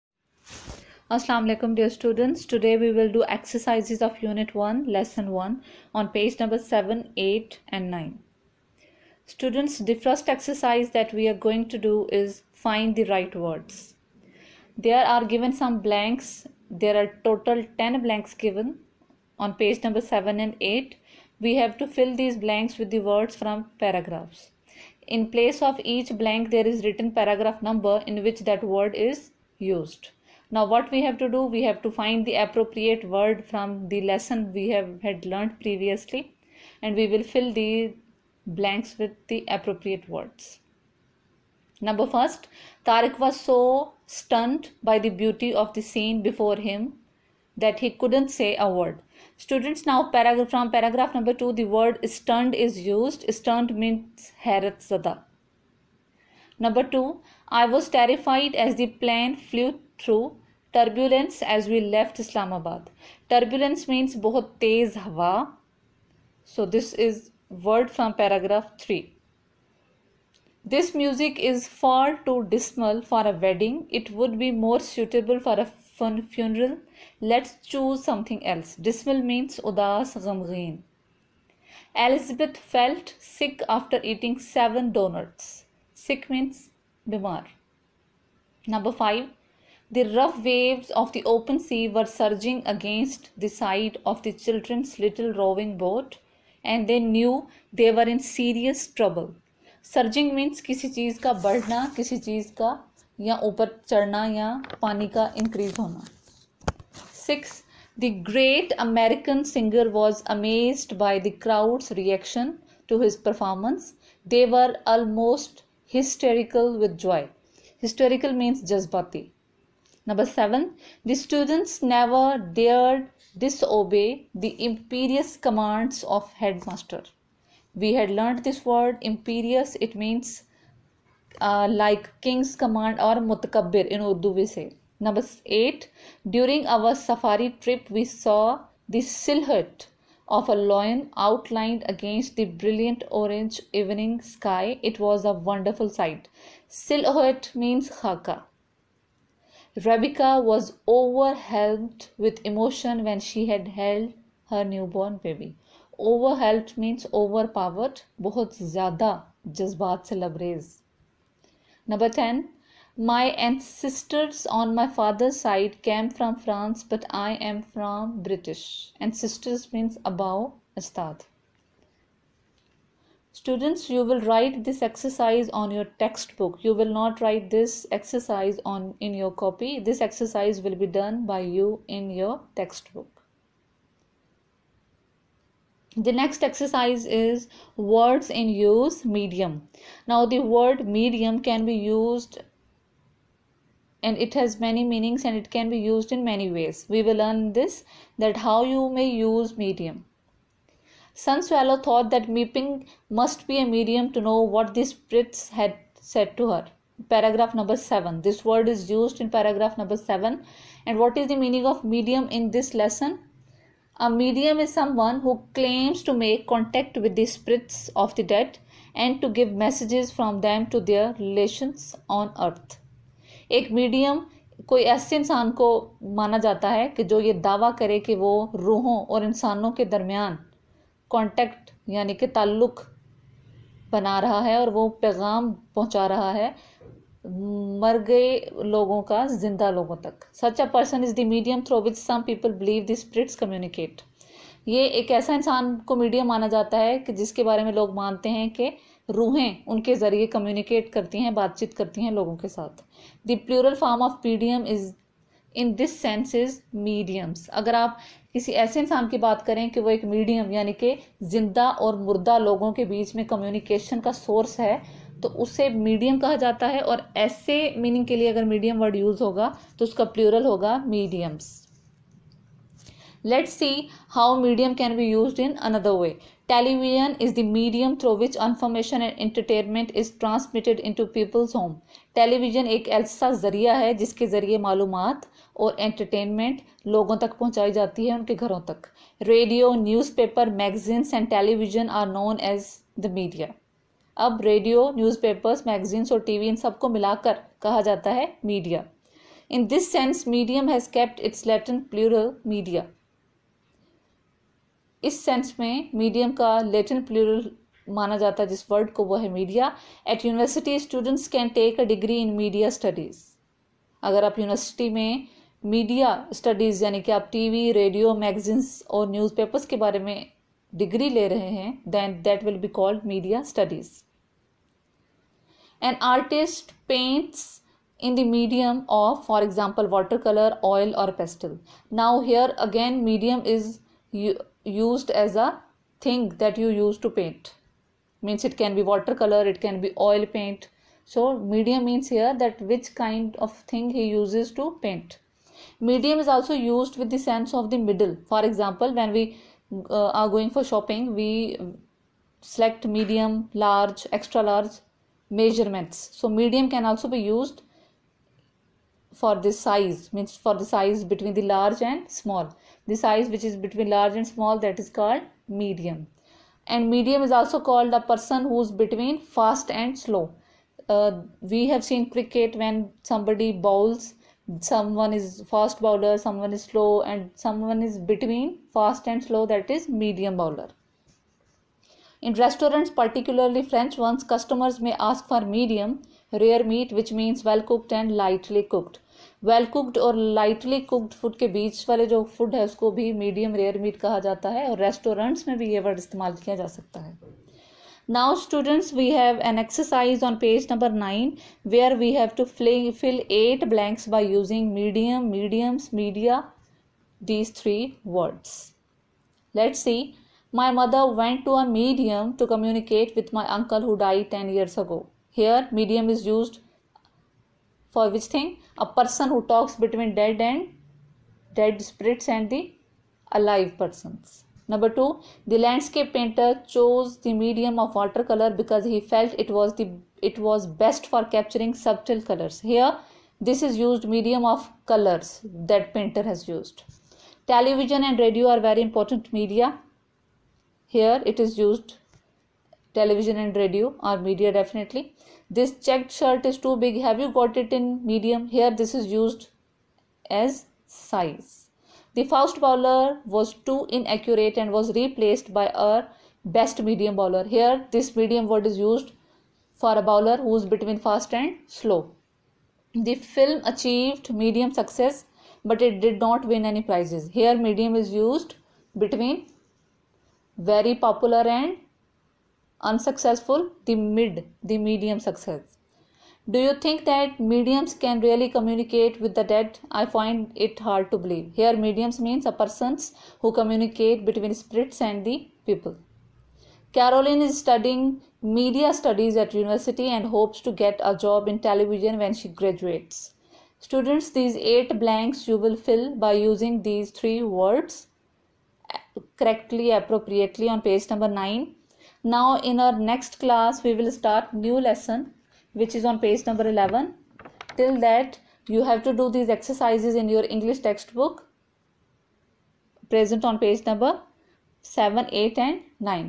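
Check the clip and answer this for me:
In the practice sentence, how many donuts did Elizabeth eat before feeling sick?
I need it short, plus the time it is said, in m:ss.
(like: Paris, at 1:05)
7, at 1:24.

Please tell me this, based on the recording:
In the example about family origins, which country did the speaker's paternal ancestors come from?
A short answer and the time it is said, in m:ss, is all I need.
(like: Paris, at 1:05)
France, at 2:46.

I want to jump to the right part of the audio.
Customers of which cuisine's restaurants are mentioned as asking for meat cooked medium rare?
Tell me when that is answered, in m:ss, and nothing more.
6:23.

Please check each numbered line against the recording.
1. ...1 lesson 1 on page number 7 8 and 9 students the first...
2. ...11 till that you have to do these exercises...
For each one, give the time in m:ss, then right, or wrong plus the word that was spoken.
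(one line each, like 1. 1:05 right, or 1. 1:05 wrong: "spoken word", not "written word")
1. 0:04 right
2. 8:26 right.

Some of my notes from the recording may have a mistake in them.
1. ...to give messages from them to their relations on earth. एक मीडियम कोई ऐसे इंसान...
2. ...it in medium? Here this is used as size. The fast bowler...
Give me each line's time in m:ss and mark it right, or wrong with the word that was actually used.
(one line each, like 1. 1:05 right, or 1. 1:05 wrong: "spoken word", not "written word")
1. 3:39 right
2. 7:27 right.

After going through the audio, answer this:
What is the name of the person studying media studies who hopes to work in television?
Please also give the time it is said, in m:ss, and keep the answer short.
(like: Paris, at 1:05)
Caroline, at 8:06.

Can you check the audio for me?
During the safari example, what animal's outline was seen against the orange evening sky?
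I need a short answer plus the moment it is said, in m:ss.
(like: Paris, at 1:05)
lion, at 2:20.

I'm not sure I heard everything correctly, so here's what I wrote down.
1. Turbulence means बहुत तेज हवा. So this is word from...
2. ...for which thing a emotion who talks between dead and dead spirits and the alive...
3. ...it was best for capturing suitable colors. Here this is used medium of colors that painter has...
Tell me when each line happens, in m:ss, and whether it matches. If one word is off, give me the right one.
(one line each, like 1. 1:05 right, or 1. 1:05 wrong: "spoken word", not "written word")
1. 1:03 right
2. 6:57 wrong: "person", not "emotion"
3. 7:10 wrong: "subtle", not "suitable".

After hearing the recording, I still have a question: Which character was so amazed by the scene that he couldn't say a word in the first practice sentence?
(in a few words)
Tarik.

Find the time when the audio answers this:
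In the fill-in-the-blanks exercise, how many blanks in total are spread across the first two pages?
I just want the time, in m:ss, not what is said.
0:17.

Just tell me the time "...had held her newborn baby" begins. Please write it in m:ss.
2:33.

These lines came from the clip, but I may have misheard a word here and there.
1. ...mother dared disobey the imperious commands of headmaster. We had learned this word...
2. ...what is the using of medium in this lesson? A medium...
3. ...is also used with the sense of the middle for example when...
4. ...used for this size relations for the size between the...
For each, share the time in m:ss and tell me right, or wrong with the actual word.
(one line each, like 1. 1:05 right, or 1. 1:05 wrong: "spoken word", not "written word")
1. 2:01 wrong: "never", not "mother"
2. 3:30 wrong: "meaning", not "using"
3. 5:46 right
4. 5:57 wrong: "means", not "relations".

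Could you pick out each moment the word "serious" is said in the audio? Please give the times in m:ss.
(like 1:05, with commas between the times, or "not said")
1:38.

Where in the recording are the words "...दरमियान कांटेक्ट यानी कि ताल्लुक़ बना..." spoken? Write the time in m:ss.
3:49.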